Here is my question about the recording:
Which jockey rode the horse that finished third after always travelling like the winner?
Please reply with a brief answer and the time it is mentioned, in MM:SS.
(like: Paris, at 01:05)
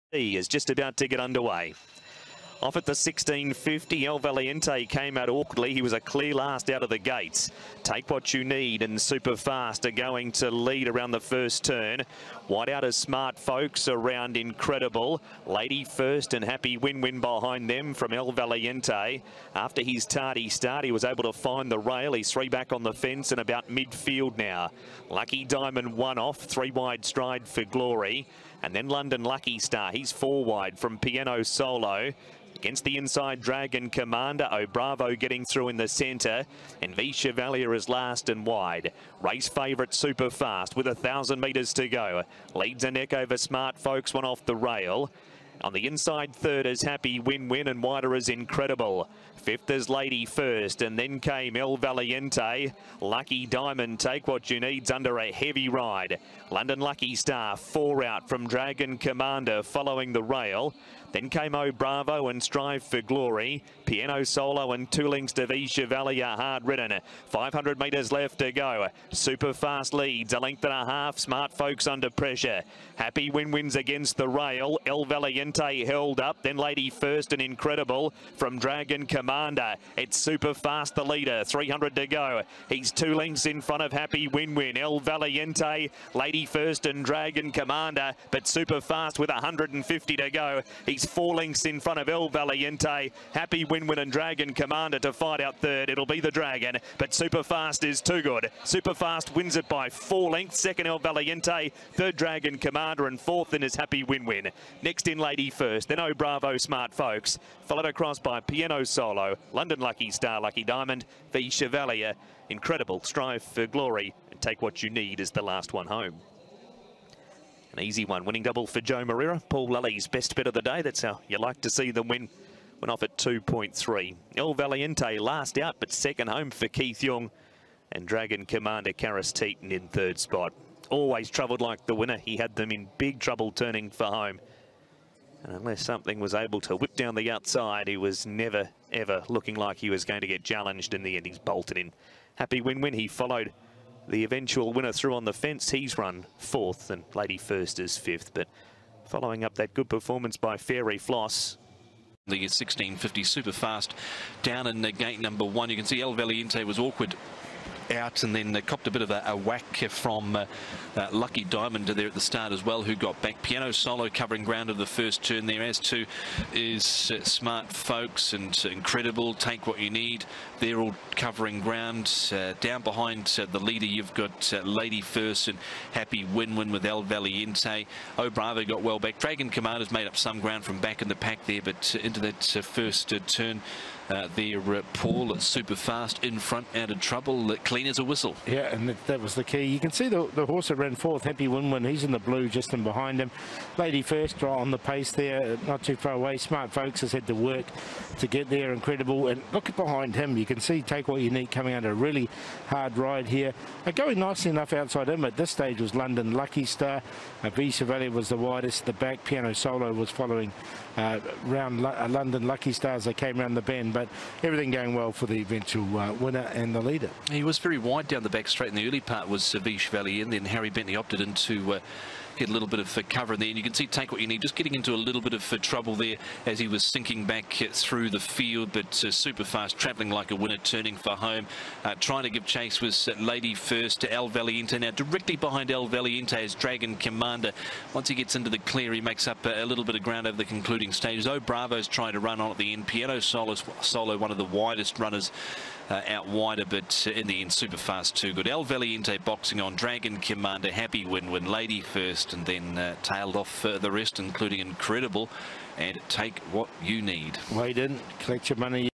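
Karis Teetan, at 02:08.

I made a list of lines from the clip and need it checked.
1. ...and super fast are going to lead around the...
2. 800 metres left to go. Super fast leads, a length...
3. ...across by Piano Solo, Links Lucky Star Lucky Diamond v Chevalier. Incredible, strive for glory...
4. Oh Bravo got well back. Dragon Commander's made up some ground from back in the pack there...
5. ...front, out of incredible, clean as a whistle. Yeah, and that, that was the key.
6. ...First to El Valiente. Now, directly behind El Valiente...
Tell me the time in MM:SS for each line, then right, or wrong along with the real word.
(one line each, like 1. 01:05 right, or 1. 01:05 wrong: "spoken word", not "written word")
1. 00:08 right
2. 01:07 wrong: "500", not "800"
3. 01:47 wrong: "London", not "Links"
4. 02:58 right
5. 03:06 wrong: "trouble", not "incredible"
6. 03:53 right.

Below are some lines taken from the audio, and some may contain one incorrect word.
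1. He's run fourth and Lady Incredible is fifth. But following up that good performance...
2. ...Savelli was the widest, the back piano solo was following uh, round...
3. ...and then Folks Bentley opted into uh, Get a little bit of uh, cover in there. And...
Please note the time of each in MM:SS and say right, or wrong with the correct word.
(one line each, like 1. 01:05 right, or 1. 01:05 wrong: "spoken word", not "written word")
1. 02:25 wrong: "First", not "Incredible"
2. 03:27 right
3. 03:40 wrong: "Harry", not "Folks".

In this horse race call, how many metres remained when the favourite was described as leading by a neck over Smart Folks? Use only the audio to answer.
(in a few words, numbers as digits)
1000.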